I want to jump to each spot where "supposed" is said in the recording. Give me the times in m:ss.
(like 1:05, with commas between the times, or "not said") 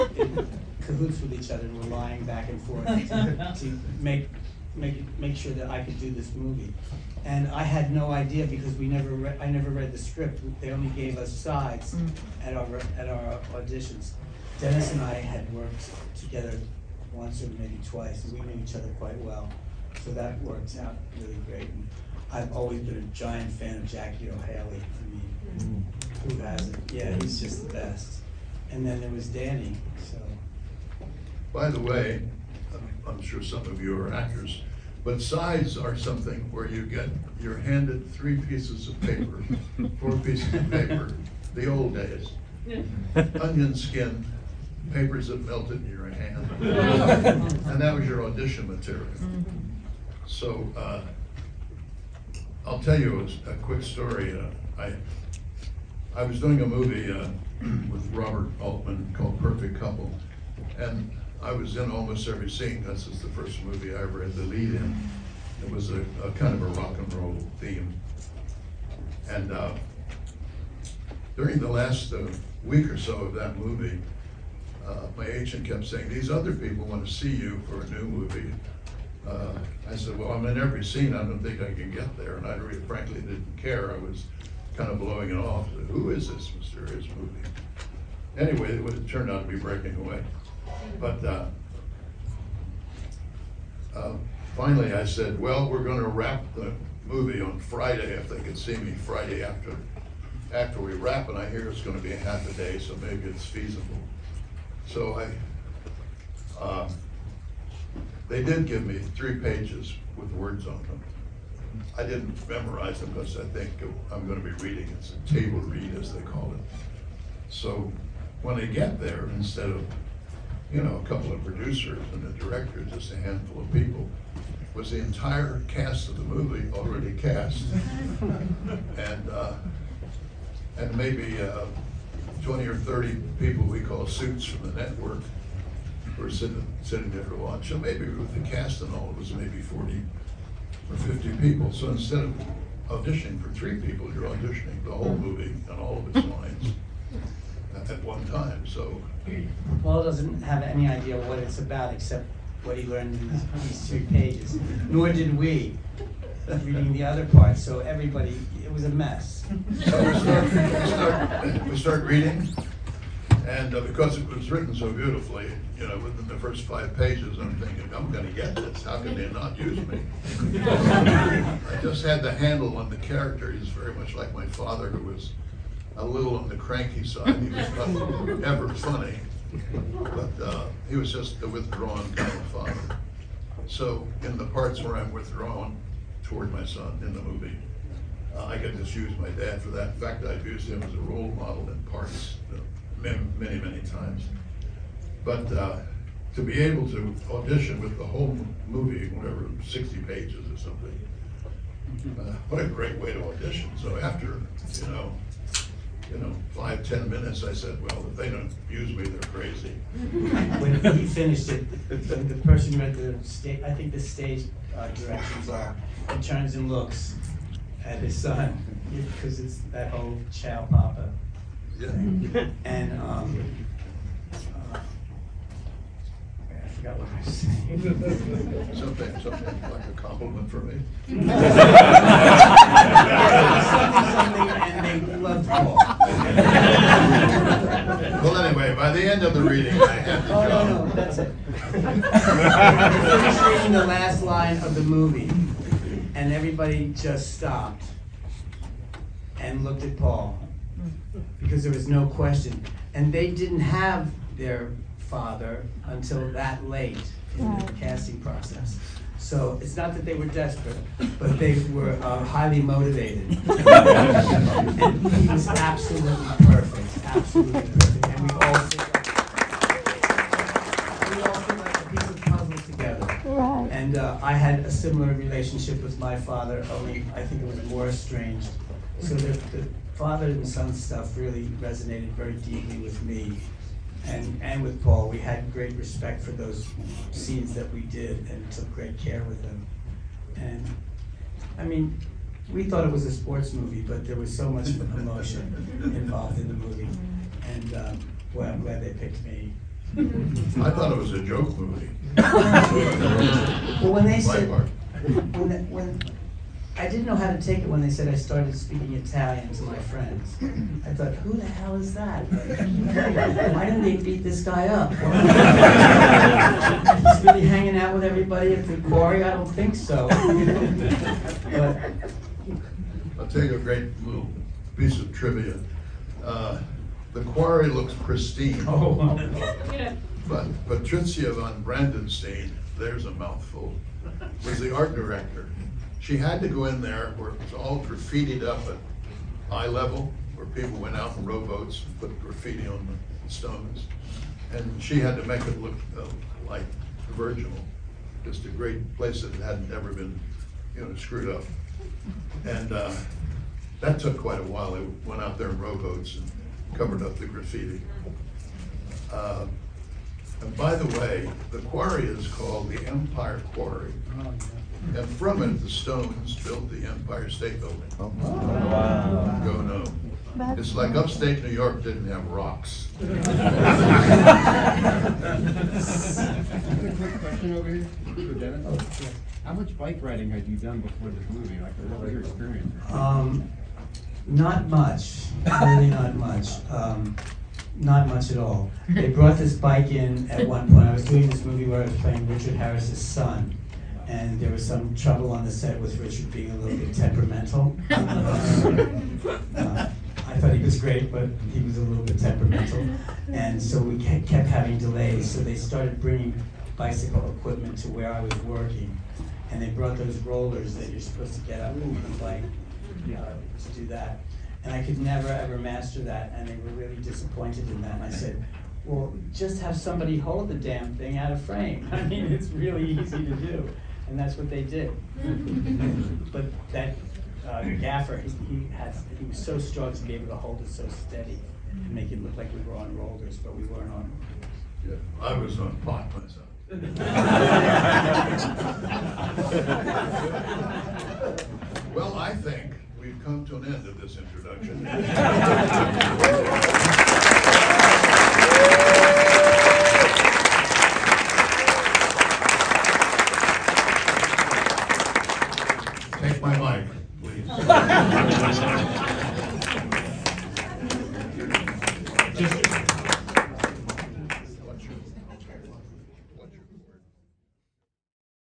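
6:51.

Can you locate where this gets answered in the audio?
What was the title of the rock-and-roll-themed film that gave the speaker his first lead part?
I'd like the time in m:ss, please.
0:59.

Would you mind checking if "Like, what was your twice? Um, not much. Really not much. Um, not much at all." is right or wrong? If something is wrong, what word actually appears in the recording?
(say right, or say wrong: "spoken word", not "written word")
wrong: "experience", not "twice".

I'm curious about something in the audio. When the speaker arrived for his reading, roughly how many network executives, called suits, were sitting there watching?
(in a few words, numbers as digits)
20 or 30.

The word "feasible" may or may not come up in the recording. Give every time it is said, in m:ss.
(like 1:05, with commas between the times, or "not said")
1:43.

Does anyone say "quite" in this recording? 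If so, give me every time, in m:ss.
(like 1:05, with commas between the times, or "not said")
0:18, 5:54.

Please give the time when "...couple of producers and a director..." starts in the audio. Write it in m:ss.
2:01.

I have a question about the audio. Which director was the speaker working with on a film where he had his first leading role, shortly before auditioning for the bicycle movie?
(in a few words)
Robert Altman.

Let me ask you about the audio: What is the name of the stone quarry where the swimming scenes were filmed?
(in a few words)
Empire Quarry.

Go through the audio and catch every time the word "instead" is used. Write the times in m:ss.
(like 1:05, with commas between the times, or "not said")
1:59, 2:21.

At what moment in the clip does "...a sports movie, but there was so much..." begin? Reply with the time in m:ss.
4:53.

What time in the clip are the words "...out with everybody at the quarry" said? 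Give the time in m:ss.
5:17.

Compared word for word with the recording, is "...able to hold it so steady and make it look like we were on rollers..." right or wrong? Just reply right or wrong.
right.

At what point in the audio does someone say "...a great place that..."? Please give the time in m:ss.
5:48.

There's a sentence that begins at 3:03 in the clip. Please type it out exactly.
So in the parts where I'm withdrawn toward my son in the movie, uh, I get just use my dad for that.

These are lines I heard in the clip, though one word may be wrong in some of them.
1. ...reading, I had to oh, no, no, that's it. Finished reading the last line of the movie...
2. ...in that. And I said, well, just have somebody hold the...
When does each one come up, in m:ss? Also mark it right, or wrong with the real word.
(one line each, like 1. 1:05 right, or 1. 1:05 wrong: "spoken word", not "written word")
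1. 3:59 right
2. 6:57 right.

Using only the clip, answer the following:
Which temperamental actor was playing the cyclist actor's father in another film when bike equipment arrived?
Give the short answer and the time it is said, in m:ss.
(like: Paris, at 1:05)
Richard Harris, at 6:32.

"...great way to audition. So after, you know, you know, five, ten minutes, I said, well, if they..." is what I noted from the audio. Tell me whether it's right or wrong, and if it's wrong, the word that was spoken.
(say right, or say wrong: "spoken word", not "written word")
right.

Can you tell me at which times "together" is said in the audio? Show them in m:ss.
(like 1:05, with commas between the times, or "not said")
0:16, 4:32.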